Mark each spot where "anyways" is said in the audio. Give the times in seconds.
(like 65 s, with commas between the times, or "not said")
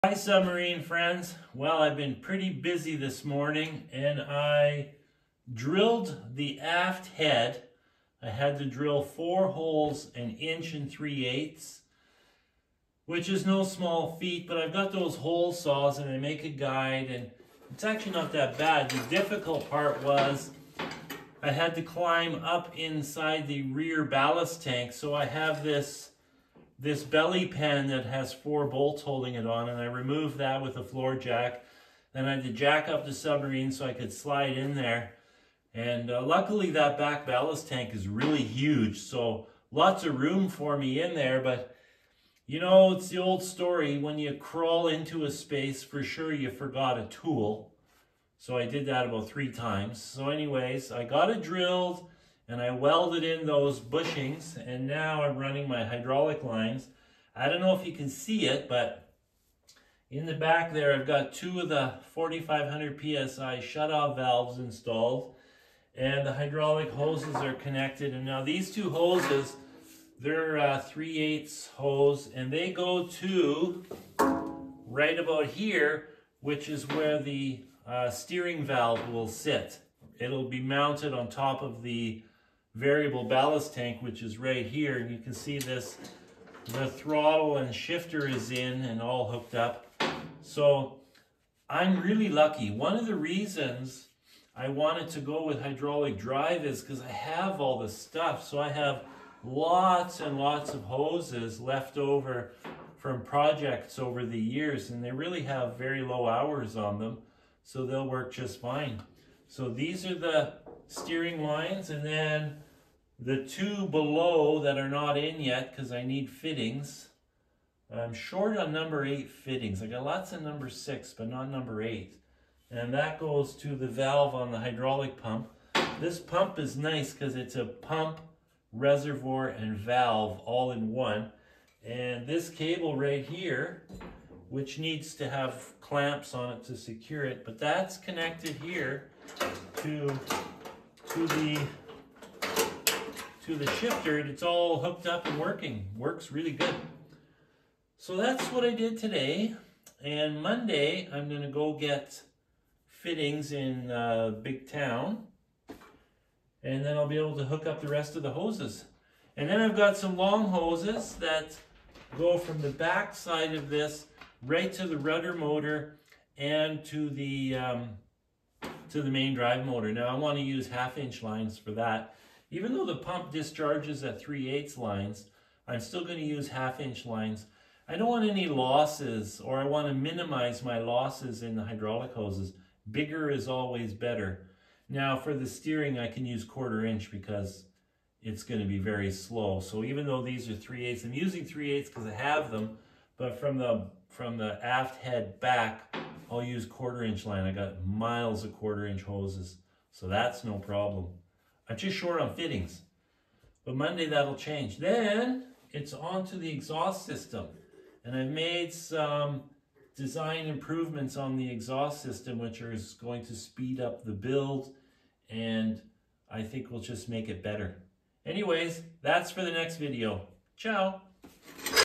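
50 s, 218 s.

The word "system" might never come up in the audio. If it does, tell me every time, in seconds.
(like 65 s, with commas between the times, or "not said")
207 s, 212 s.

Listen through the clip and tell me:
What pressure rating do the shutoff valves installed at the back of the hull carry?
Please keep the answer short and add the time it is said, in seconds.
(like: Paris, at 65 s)
4500 PSI, at 62 s.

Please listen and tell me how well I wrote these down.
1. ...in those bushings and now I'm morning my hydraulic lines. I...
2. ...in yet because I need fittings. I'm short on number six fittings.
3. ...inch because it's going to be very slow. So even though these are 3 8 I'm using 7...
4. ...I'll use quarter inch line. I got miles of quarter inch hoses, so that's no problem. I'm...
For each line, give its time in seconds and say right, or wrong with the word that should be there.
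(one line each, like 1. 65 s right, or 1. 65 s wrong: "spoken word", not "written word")
1. 53 s wrong: "running", not "morning"
2. 115 s wrong: "eight", not "six"
3. 186 s wrong: "3", not "7"
4. 196 s right.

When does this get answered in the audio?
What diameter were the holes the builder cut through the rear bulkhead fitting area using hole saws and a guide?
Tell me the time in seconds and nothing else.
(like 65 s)
10 s.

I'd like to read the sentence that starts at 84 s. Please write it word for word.
And you can see this, the throttle and shifter is in and all hooked up.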